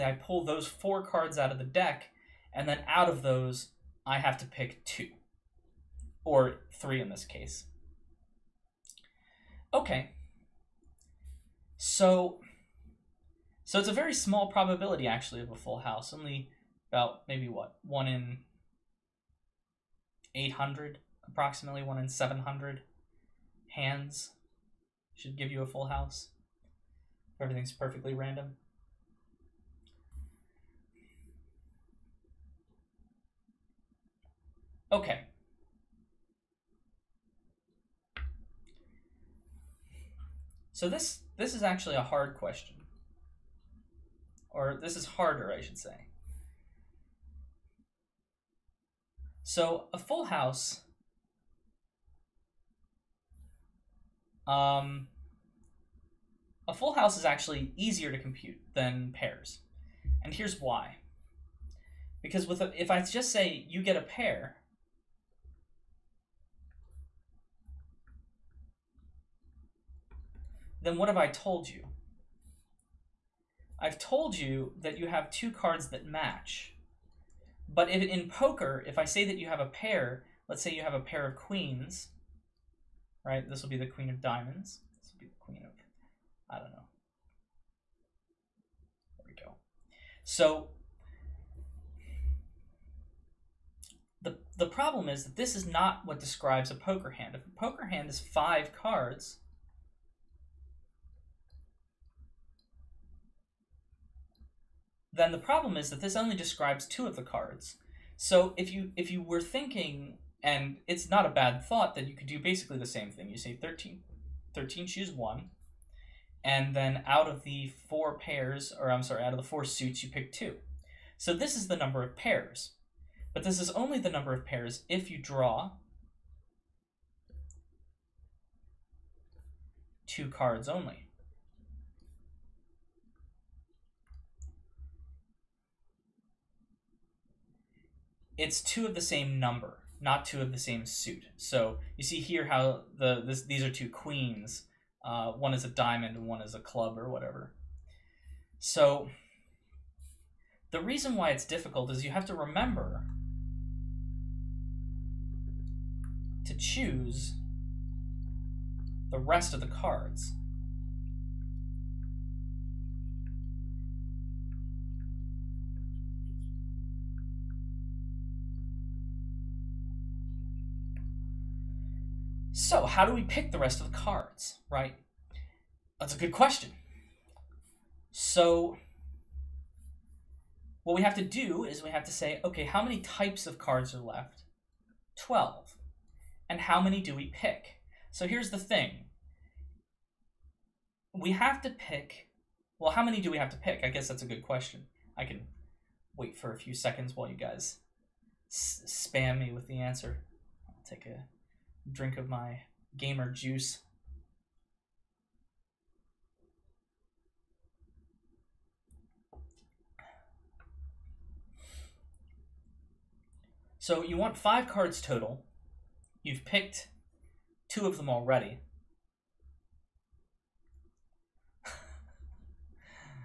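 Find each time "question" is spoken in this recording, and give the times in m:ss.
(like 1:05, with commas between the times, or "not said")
0:42, 2:56, 3:14.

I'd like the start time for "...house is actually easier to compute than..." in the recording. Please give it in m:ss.
0:56.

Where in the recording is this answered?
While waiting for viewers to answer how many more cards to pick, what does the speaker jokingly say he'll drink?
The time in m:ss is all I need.
3:22.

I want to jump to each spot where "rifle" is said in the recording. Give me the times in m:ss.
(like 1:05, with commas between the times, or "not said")
not said.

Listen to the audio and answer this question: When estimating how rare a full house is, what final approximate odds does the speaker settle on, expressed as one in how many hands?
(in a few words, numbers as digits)
1 in 700.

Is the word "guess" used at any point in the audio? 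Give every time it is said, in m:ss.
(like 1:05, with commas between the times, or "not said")
3:13.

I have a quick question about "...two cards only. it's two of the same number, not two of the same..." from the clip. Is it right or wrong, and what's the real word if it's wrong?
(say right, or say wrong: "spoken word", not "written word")
right.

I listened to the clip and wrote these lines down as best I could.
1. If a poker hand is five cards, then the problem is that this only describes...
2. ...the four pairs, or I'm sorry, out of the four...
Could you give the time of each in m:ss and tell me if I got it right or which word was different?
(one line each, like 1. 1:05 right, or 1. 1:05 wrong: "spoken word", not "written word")
1. 1:37 right
2. 1:57 right.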